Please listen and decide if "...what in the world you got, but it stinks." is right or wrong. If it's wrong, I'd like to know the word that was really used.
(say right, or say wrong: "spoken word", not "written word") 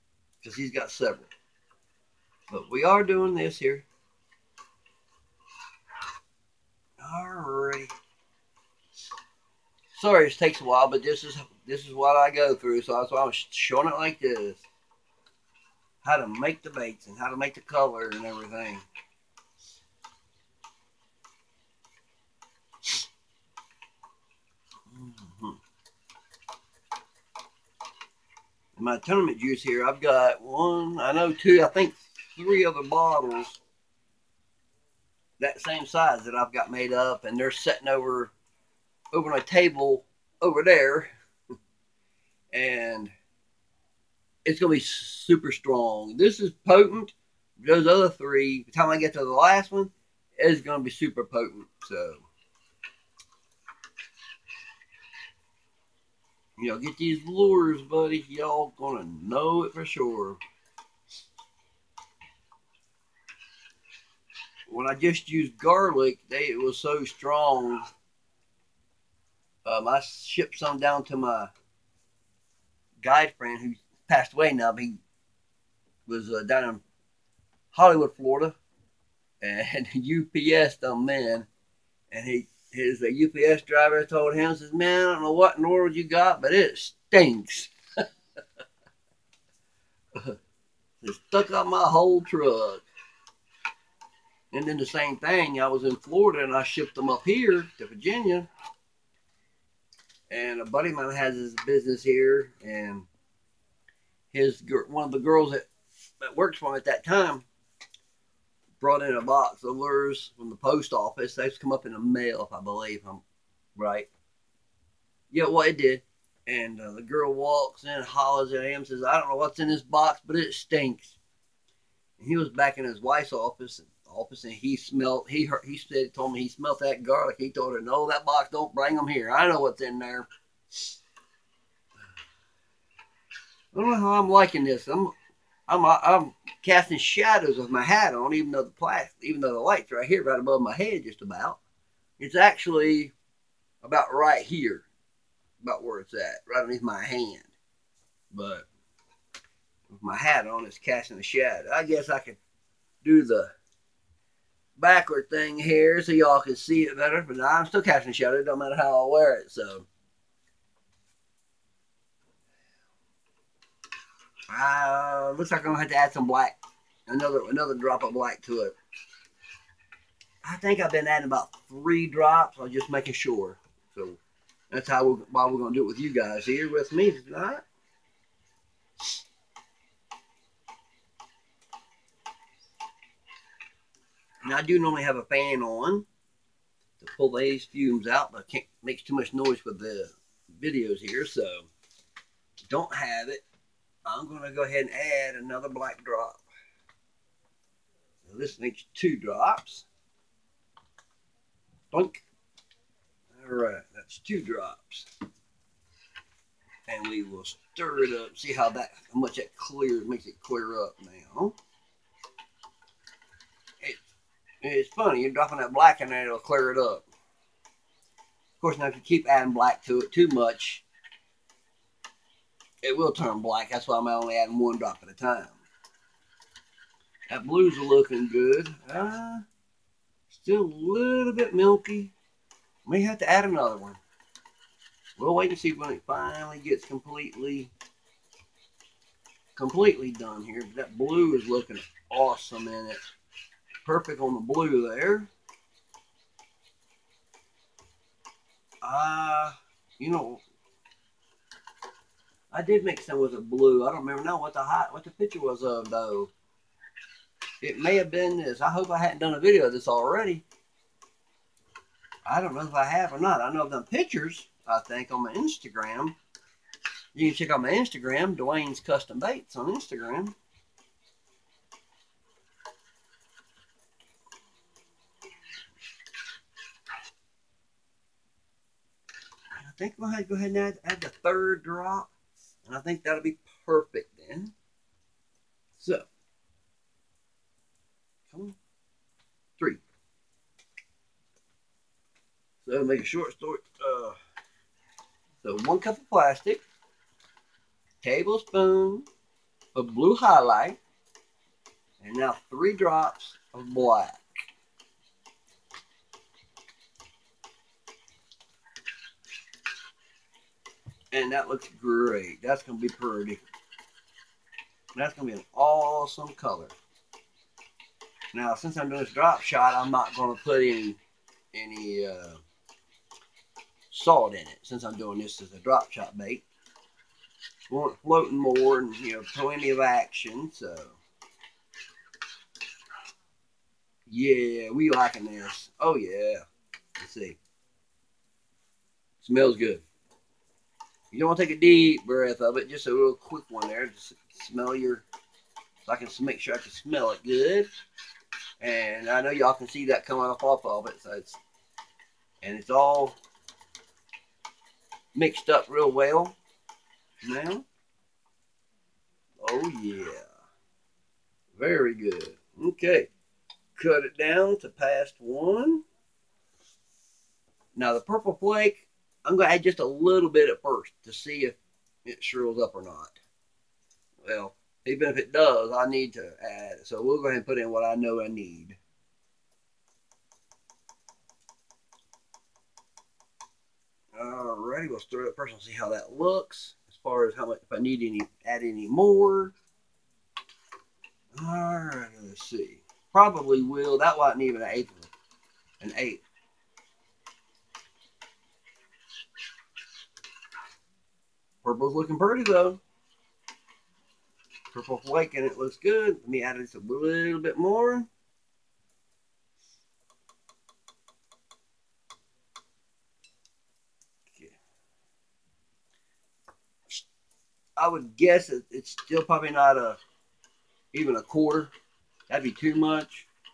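right.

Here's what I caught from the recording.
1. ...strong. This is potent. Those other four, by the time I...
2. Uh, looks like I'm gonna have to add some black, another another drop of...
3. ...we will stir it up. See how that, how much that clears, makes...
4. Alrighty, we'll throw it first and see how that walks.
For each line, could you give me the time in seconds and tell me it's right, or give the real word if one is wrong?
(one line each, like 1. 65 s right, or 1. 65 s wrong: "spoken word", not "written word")
1. 45 s wrong: "three", not "four"
2. 164 s right
3. 207 s right
4. 384 s wrong: "looks", not "walks".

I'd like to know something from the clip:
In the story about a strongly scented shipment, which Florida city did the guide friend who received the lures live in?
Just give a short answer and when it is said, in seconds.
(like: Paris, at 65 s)
Hollywood, Florida, at 77 s.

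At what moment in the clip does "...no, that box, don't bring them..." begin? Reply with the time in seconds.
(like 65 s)
127 s.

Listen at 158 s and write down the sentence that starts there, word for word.
It don't matter how I wear it, so.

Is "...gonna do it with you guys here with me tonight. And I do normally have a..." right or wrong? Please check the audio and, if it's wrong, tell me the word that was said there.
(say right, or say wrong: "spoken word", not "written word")
right.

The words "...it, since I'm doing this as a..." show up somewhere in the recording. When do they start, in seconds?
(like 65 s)
324 s.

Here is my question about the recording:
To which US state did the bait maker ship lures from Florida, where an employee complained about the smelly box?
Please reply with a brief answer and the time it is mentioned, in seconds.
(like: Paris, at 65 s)
Virginia, at 97 s.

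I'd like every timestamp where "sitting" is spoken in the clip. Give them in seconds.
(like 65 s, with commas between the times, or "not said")
37 s.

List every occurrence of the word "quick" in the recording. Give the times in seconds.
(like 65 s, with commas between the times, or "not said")
343 s.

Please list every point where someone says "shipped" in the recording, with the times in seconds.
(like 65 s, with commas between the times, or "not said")
70 s, 96 s.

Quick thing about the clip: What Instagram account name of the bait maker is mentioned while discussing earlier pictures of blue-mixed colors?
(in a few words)
Duane's Custom Baits.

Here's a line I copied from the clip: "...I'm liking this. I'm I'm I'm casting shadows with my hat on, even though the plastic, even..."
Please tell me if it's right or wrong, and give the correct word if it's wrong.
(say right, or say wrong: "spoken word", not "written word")
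right.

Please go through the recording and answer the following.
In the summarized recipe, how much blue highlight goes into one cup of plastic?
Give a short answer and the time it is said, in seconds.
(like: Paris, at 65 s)
1 tablespoon, at 298 s.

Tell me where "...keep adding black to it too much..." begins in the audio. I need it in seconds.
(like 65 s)
219 s.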